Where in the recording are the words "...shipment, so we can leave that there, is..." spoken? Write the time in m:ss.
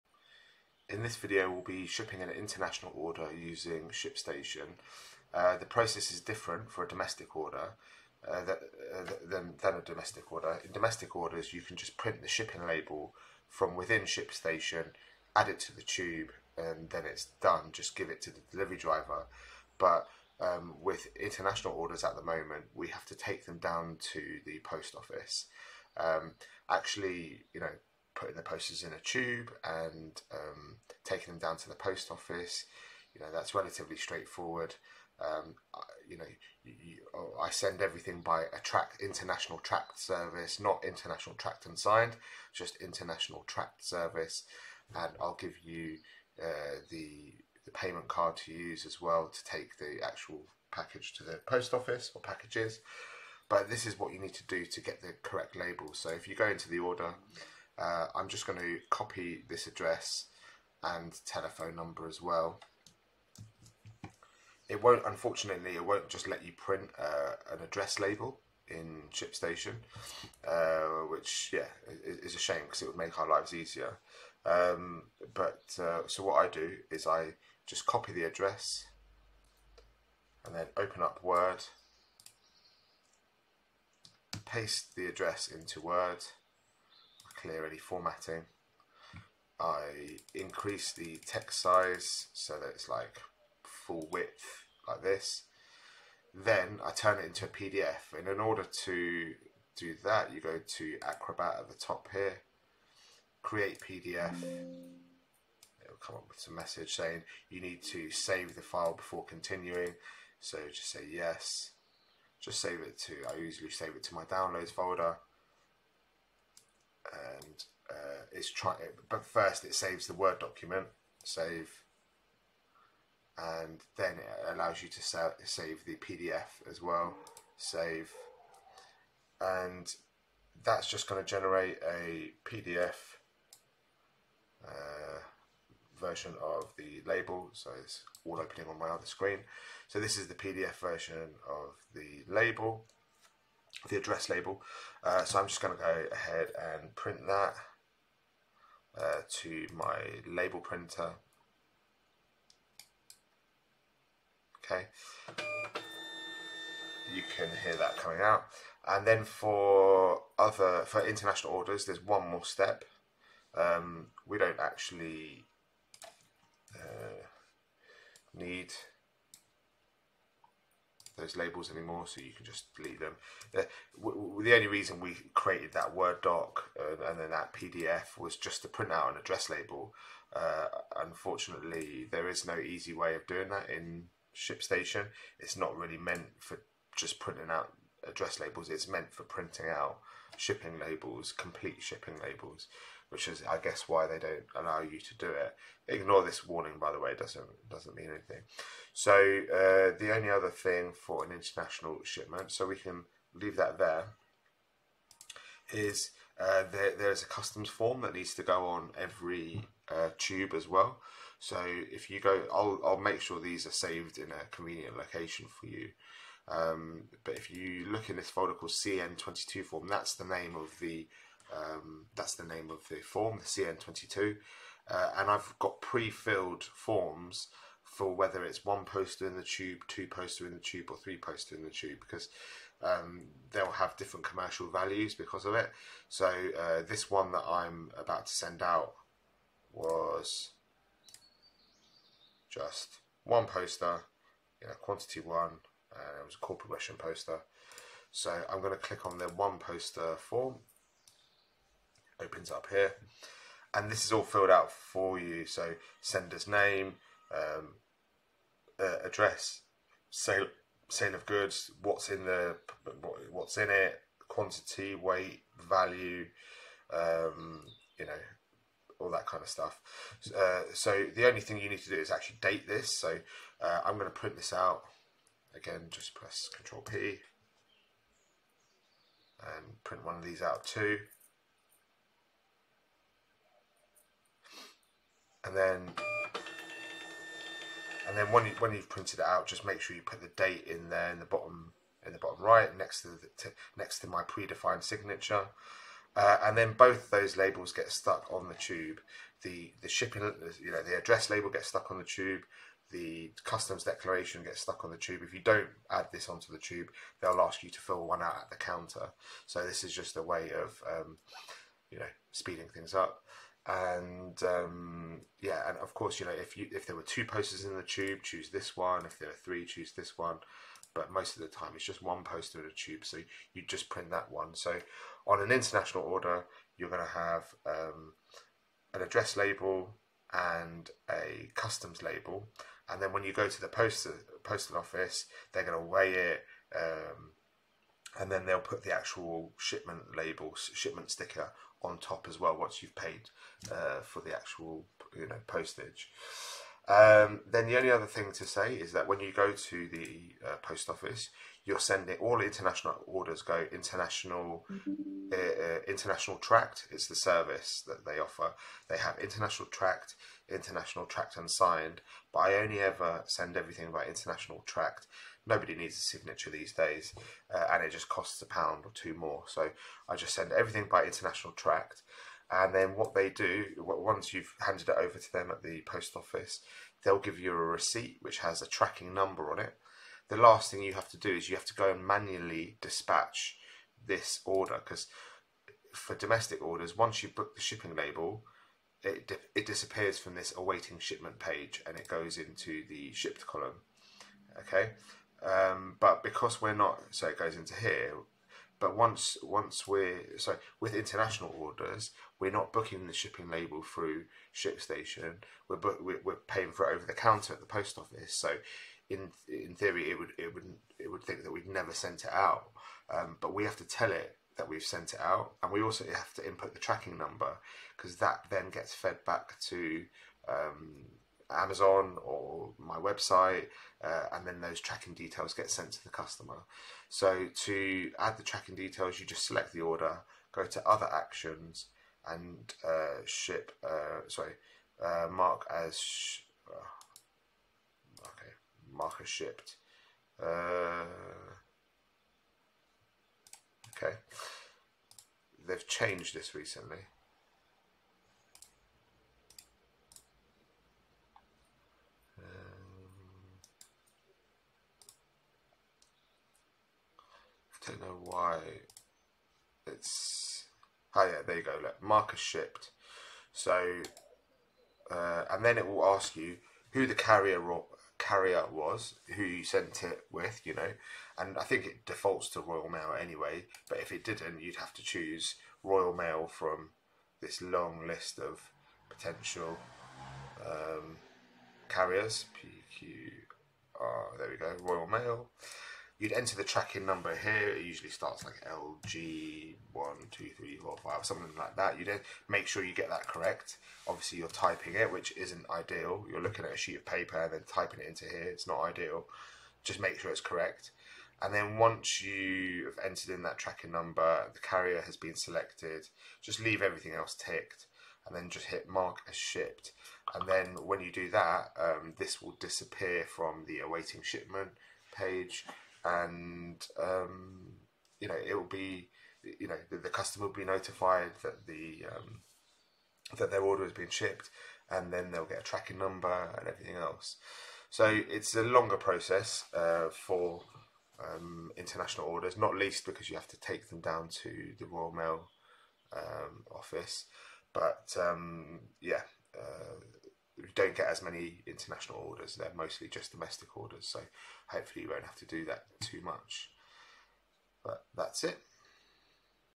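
3:22.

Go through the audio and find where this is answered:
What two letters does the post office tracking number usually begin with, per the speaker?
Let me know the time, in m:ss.
8:08.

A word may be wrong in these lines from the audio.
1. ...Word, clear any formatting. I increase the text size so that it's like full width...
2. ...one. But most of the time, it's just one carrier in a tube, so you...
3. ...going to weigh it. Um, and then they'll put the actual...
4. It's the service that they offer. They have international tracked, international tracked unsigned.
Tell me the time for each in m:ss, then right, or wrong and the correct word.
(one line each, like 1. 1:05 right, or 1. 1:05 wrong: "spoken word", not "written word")
1. 1:25 right
2. 5:20 wrong: "poster", not "carrier"
3. 5:35 right
4. 5:56 right.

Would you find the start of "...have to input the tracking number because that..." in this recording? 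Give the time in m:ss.
6:56.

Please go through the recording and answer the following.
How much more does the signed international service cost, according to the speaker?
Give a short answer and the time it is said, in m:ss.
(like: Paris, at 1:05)
a pound or two, at 6:08.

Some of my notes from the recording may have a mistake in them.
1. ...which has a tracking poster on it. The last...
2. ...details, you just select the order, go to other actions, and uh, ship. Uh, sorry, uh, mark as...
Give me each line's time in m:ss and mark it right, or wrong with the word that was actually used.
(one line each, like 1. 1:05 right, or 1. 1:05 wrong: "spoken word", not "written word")
1. 6:18 wrong: "number", not "poster"
2. 7:08 right.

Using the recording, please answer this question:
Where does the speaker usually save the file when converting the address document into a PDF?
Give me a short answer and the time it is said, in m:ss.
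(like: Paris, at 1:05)
downloads folder, at 1:54.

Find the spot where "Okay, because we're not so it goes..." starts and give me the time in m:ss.
6:34.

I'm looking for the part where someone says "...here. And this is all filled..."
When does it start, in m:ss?
4:12.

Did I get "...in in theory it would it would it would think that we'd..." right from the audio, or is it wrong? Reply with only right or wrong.
right.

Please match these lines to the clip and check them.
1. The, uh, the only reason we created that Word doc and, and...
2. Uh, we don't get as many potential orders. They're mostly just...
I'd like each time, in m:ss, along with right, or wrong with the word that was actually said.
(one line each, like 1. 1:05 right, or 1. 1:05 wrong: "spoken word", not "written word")
1. 2:53 right
2. 8:59 wrong: "international", not "potential".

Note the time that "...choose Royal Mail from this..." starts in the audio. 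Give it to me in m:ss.
7:55.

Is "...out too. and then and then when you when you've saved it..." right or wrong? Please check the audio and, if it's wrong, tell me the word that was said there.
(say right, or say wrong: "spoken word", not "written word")
wrong: "printed", not "saved".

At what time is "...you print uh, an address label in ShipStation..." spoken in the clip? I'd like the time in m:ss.
1:06.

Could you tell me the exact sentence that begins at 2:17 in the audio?
So it's all opening on my other screen.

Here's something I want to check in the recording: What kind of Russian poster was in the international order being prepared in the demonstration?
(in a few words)
corporate Russian poster.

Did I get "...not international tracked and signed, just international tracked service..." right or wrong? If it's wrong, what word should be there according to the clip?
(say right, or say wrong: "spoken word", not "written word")
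right.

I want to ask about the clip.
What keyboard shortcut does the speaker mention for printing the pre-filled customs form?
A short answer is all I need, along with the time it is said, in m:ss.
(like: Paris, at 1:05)
Control P, at 4:36.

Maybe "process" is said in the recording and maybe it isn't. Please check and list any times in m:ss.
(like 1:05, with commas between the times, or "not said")
0:05, 8:48.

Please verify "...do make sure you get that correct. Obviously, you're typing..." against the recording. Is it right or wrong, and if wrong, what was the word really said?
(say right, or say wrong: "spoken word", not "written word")
right.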